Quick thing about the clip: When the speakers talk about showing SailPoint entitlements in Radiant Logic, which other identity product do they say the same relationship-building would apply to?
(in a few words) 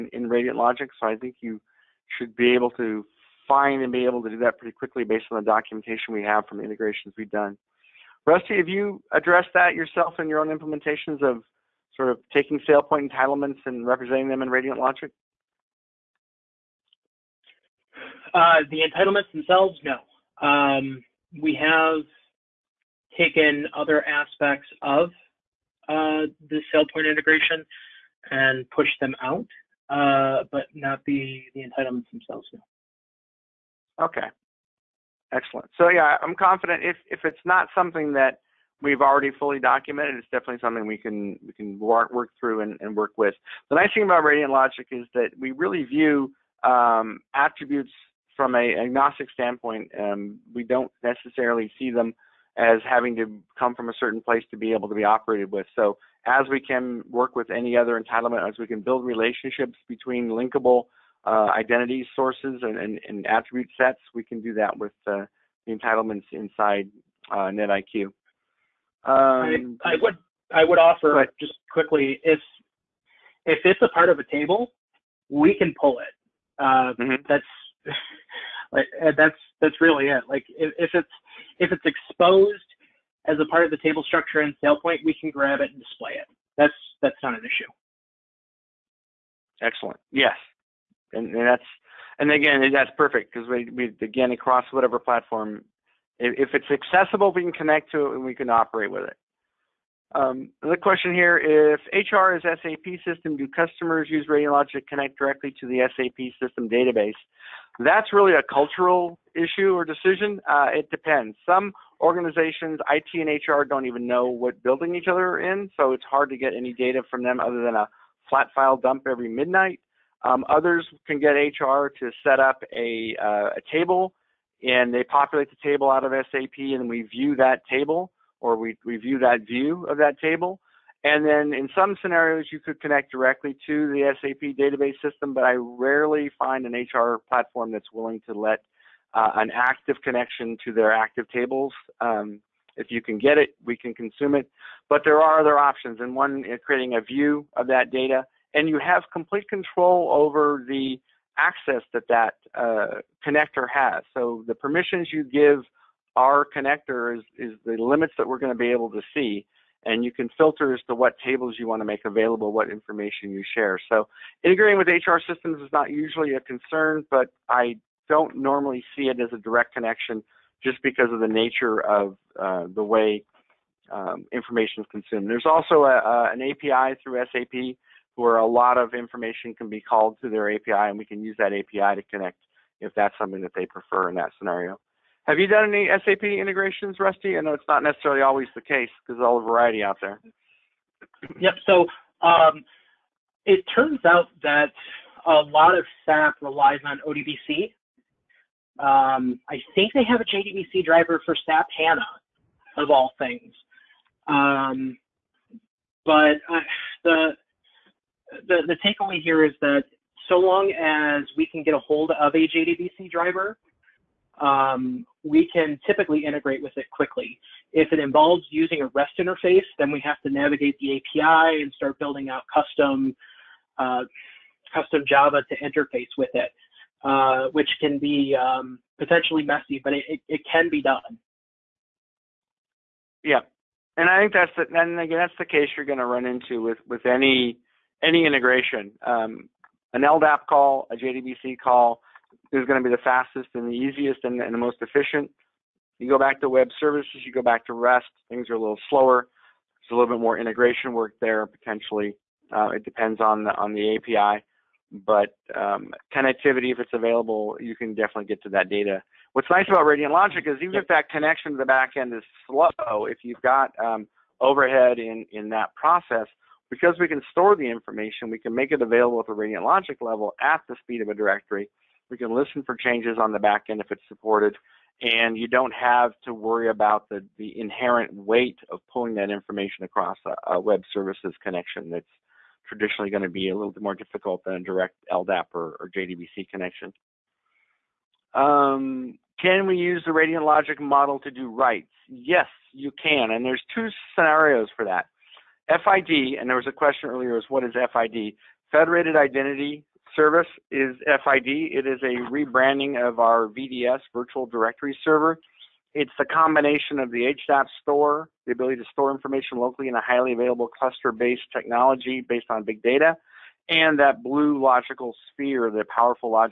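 NetIQ.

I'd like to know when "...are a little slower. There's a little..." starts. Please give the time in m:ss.
4:08.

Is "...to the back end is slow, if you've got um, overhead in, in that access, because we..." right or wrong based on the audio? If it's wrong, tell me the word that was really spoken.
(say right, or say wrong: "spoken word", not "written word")
wrong: "process", not "access".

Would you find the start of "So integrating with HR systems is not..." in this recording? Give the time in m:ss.
2:43.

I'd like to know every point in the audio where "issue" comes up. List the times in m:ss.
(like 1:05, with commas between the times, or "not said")
1:27, 1:49.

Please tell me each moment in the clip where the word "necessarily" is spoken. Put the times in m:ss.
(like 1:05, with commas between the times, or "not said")
0:51, 3:07.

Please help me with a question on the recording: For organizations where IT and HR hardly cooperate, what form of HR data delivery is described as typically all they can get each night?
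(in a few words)
A flat file dump.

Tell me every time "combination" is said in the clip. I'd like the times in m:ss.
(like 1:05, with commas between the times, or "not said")
5:06.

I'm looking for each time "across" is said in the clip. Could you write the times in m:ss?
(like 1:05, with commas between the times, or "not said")
1:34, 4:39.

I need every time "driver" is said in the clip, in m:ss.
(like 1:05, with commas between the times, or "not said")
3:20, 3:33.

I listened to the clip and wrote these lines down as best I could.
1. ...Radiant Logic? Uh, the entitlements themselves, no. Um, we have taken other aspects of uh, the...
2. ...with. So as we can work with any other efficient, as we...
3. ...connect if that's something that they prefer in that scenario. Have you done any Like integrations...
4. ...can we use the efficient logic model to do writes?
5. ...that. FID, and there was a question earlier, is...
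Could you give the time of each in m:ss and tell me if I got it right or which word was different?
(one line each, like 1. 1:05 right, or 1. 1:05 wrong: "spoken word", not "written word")
1. 0:14 right
2. 0:55 wrong: "entitlement", not "efficient"
3. 3:02 wrong: "SAP", not "Like"
4. 4:49 wrong: "radiant", not "efficient"
5. 4:54 right.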